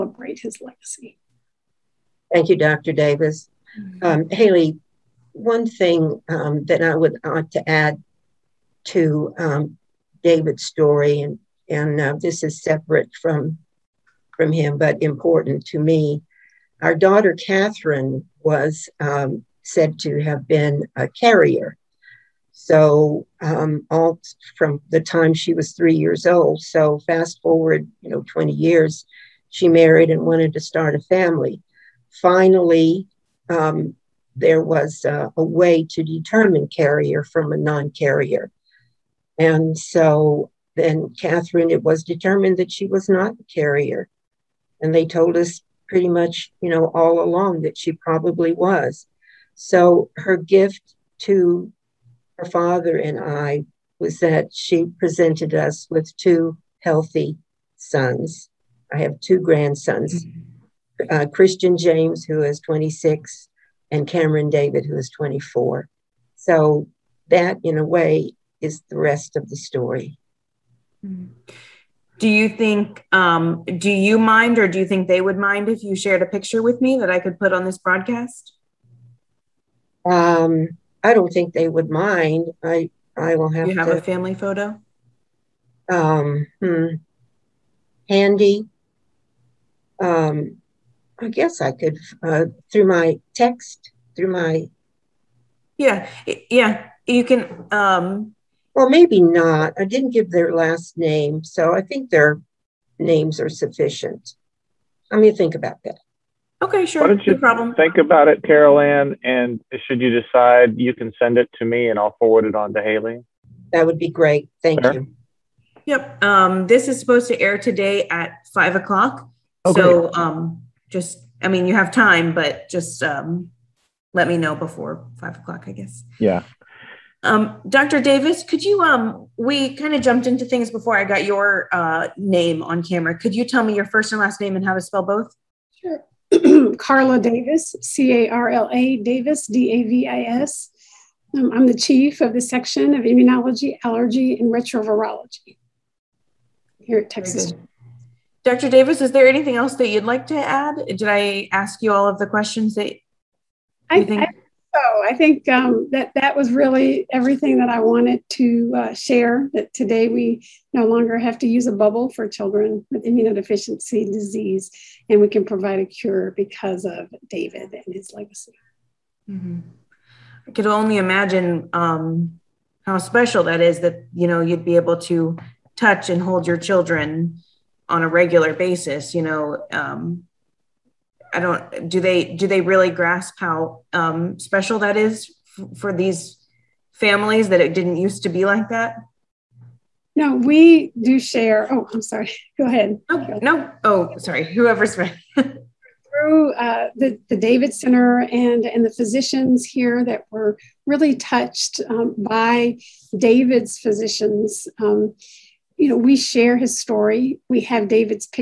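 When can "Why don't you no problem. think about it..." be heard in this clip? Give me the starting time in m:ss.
1:47.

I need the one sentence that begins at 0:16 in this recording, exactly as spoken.
Our daughter Catherine was um, said to have been a carrier.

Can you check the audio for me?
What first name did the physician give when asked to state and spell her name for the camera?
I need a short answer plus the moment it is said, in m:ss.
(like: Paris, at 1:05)
Carla, at 2:16.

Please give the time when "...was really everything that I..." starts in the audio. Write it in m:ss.
2:36.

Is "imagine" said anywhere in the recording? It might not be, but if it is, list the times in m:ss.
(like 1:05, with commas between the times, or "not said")
2:50.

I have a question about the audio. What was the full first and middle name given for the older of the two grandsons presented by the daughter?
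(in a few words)
Christian James.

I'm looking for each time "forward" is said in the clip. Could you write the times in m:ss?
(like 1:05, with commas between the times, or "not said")
0:27, 1:52.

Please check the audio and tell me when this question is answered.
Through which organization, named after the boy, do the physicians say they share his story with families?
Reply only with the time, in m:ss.
3:17.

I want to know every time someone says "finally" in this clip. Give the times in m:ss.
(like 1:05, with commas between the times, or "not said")
0:32.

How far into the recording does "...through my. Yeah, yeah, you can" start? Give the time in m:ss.
1:34.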